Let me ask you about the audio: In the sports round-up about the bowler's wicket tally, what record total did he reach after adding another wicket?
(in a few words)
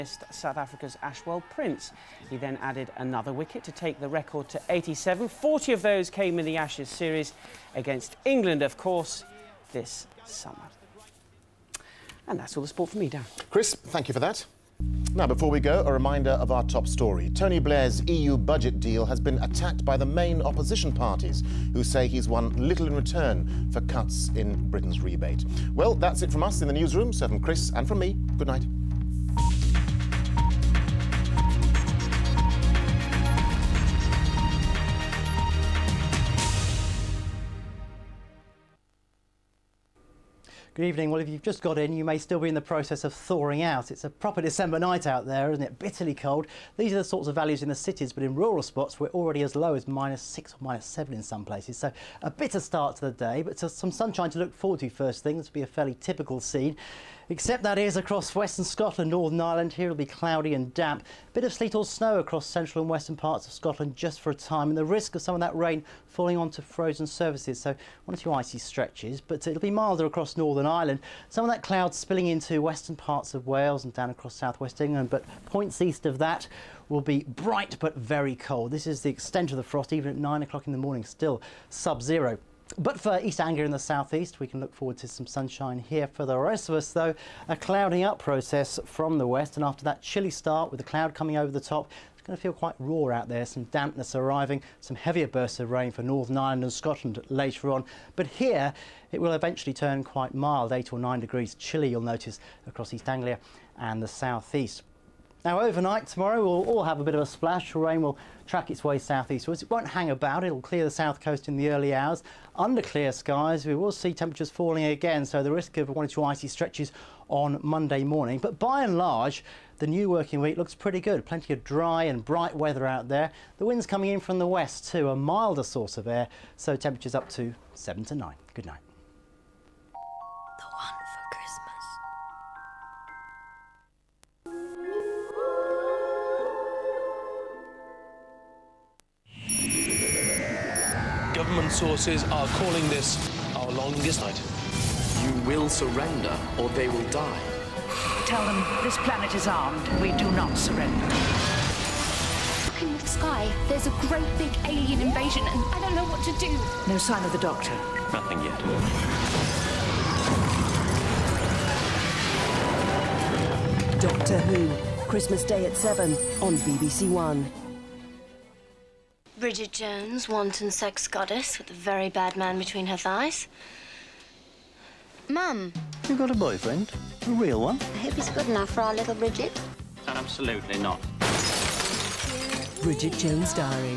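87.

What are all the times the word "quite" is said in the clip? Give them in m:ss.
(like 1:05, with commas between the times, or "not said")
1:32, 1:40.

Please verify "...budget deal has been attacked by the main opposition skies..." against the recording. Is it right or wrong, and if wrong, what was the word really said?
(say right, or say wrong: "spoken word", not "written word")
wrong: "parties", not "skies".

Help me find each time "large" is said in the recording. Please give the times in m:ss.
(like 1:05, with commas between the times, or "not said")
1:58.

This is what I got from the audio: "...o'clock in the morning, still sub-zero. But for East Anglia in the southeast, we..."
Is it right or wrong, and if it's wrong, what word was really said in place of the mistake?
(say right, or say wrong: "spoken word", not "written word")
right.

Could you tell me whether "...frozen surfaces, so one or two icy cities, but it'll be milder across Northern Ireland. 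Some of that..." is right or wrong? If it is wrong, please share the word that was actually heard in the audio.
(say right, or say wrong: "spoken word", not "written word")
wrong: "stretches", not "cities".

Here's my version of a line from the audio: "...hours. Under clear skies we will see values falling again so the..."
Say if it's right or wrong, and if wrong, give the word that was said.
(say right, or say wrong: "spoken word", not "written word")
wrong: "temperatures", not "values".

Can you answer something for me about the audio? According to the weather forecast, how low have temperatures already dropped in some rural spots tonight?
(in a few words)
-6 or -7.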